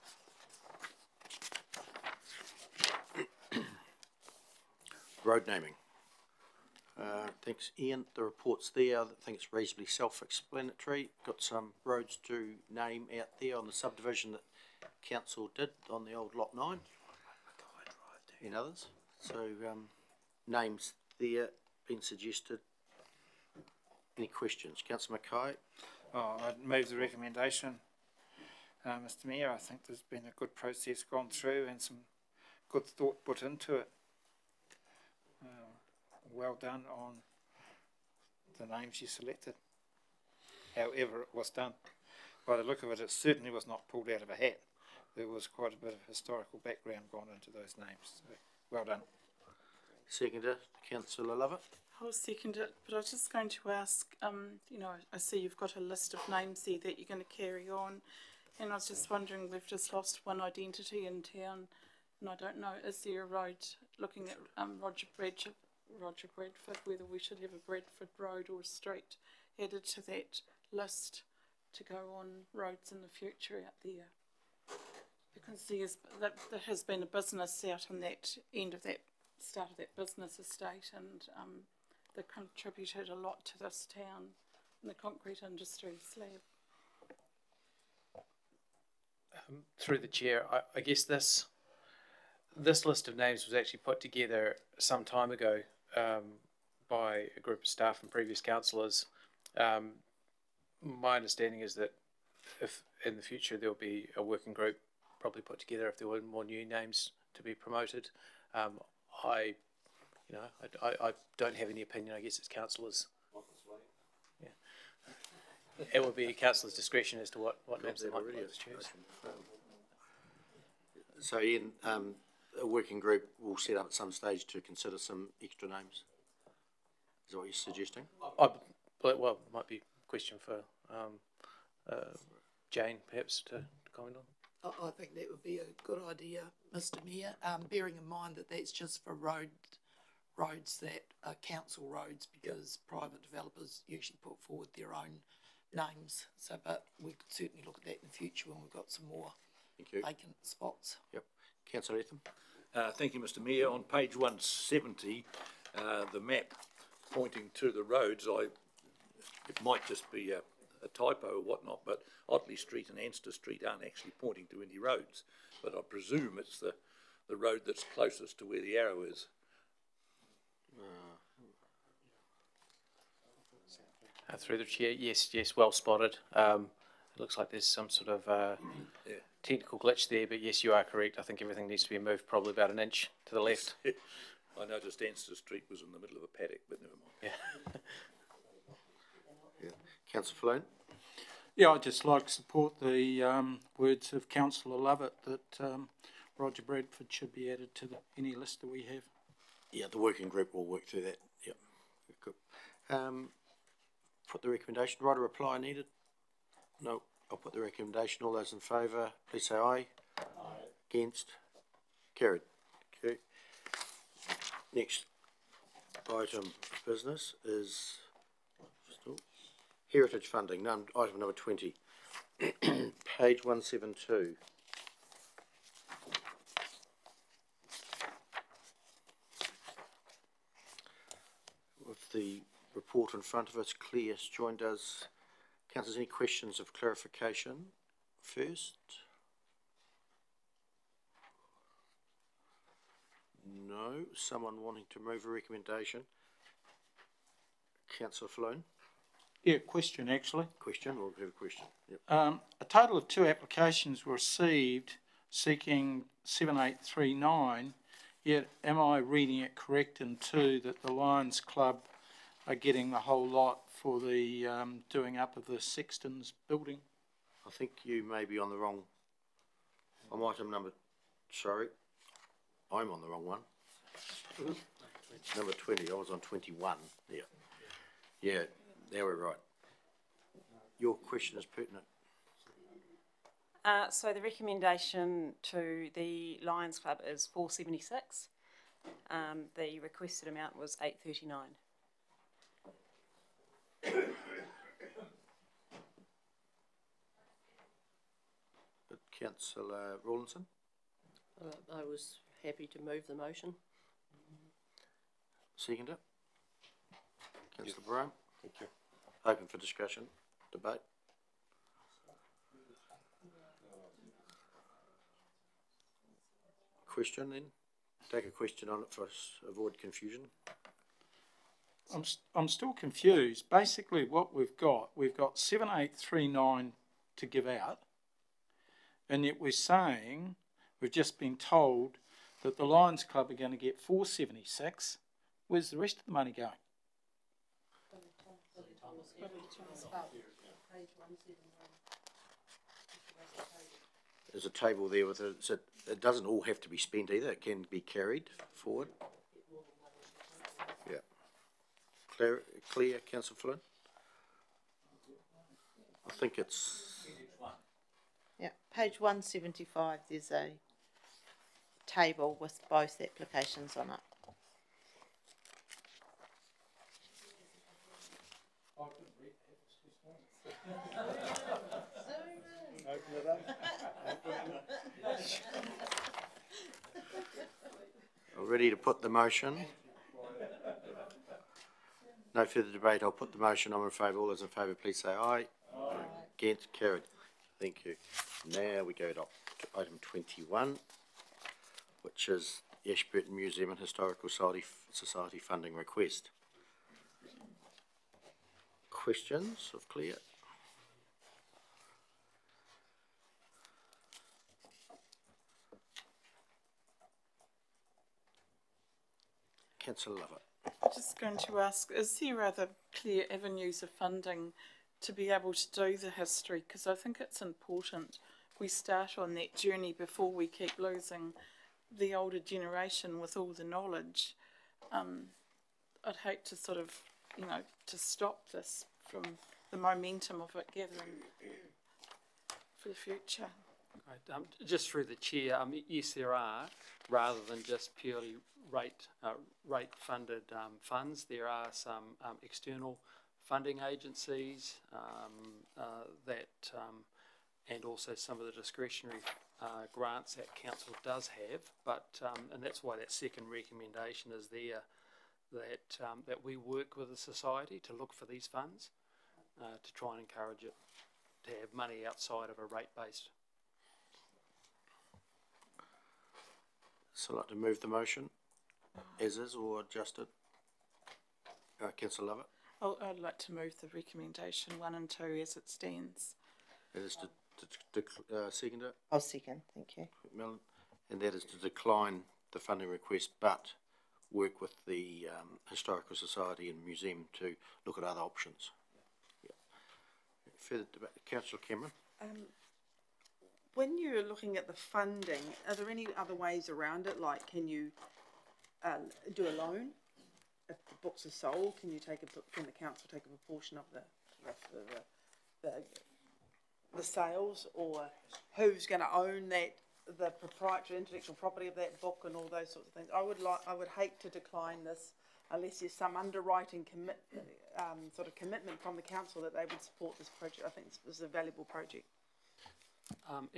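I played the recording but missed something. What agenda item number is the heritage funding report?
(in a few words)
20.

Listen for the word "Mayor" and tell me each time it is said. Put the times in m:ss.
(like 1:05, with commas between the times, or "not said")
0:29, 2:17, 2:33.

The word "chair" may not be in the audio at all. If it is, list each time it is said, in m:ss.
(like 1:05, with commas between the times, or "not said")
1:30, 2:54, 7:15.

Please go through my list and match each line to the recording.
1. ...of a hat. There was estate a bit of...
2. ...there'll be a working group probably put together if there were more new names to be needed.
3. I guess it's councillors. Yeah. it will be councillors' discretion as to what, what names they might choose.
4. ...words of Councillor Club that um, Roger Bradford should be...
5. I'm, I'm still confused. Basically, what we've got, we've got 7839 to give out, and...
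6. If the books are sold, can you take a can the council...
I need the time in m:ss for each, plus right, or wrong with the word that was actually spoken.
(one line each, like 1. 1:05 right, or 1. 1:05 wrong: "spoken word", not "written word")
1. 0:44 wrong: "quite", not "estate"
2. 1:43 wrong: "promoted", not "needed"
3. 1:52 right
4. 3:13 wrong: "Lovett", not "Club"
5. 5:21 right
6. 8:20 right.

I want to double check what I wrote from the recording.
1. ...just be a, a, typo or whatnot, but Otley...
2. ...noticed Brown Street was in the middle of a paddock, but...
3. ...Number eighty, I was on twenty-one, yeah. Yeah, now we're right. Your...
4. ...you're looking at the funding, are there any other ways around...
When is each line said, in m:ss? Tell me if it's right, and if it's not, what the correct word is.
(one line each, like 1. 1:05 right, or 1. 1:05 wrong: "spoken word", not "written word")
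1. 2:39 right
2. 3:04 wrong: "Anster", not "Brown"
3. 4:35 wrong: "twenty", not "eighty"
4. 8:13 right.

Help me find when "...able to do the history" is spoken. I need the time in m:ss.
6:55.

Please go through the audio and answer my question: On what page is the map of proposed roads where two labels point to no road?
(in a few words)
170.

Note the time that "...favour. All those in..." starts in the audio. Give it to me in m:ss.
6:23.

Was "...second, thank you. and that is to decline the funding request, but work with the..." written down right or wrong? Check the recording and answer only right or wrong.
right.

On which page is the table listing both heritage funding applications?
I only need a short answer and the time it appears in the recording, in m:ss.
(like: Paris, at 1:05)
175, at 5:58.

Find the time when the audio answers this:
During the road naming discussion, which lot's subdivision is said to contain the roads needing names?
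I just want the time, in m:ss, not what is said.
0:16.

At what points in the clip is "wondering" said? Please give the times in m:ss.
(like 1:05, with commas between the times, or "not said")
0:59.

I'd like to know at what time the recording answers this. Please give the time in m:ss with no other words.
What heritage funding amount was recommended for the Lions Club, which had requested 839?
4:47.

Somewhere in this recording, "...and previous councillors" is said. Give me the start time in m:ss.
1:38.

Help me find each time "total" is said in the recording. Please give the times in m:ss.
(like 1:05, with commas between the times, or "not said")
4:12.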